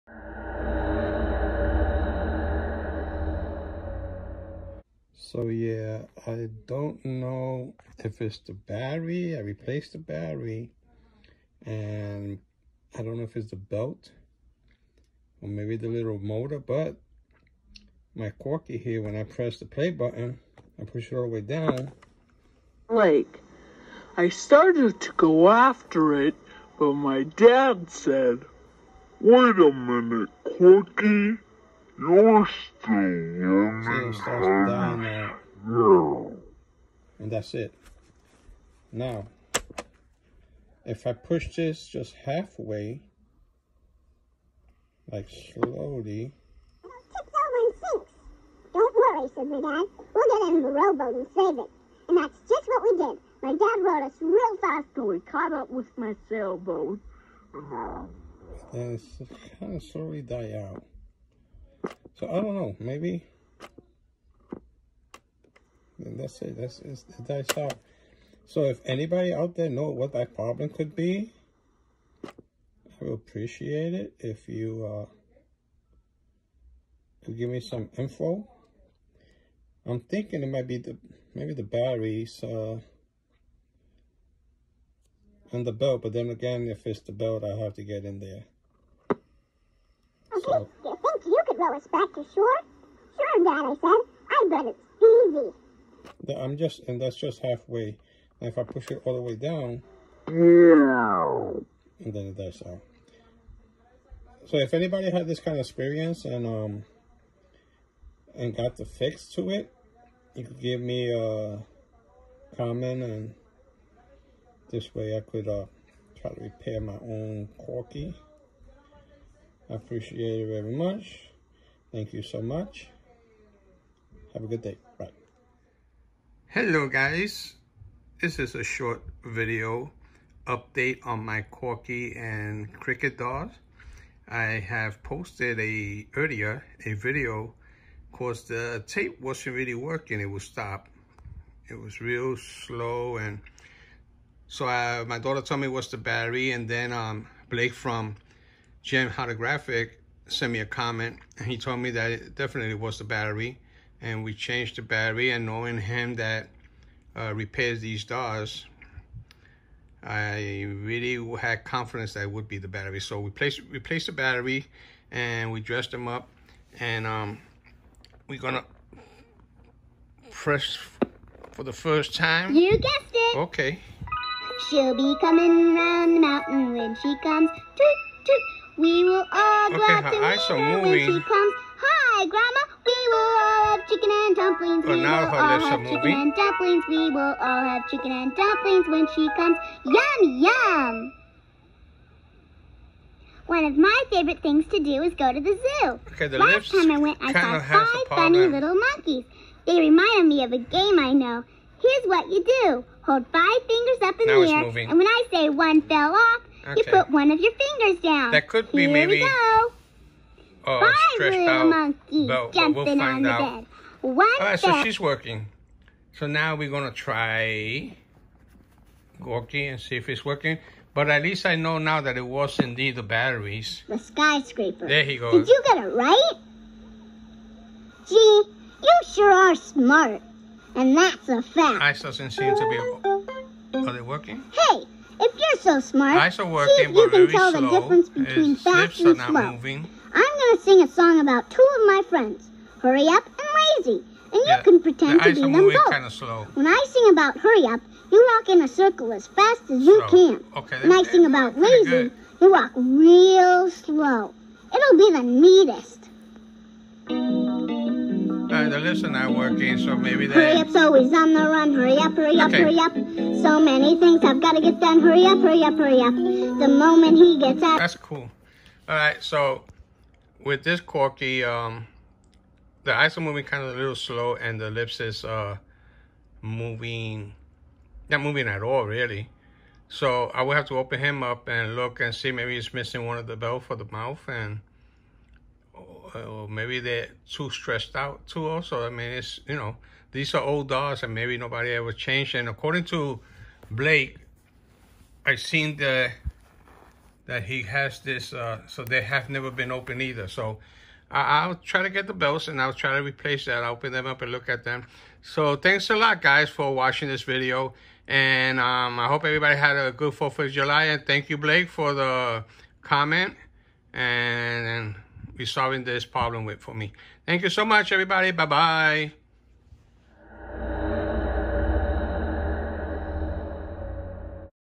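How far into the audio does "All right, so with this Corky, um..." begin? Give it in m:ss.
4:28.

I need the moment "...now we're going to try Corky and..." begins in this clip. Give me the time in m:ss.
3:36.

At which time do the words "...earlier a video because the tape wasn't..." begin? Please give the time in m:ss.
2:16.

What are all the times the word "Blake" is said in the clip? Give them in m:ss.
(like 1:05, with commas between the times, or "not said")
2:27, 4:53, 5:11.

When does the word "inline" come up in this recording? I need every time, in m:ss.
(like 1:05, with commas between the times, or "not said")
not said.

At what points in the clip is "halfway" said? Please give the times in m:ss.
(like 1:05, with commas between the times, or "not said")
0:42, 1:37.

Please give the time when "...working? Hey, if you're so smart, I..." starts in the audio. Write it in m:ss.
3:54.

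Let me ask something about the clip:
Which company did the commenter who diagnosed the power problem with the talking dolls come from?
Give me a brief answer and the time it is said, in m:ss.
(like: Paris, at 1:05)
Gem Holographic, at 2:28.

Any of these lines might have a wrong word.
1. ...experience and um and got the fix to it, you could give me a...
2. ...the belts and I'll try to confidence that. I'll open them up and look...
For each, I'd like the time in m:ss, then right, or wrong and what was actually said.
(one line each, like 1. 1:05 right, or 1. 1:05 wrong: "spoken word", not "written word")
1. 1:45 right
2. 5:02 wrong: "replace", not "confidence".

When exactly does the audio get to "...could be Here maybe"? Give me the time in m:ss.
3:28.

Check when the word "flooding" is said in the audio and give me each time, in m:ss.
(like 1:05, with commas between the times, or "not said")
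not said.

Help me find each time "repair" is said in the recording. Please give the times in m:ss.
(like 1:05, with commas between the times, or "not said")
1:56, 2:37.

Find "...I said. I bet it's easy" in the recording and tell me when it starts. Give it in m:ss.
1:33.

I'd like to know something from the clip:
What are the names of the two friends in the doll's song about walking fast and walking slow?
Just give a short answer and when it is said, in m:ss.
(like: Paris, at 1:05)
Hurry Up and Lazy, at 4:02.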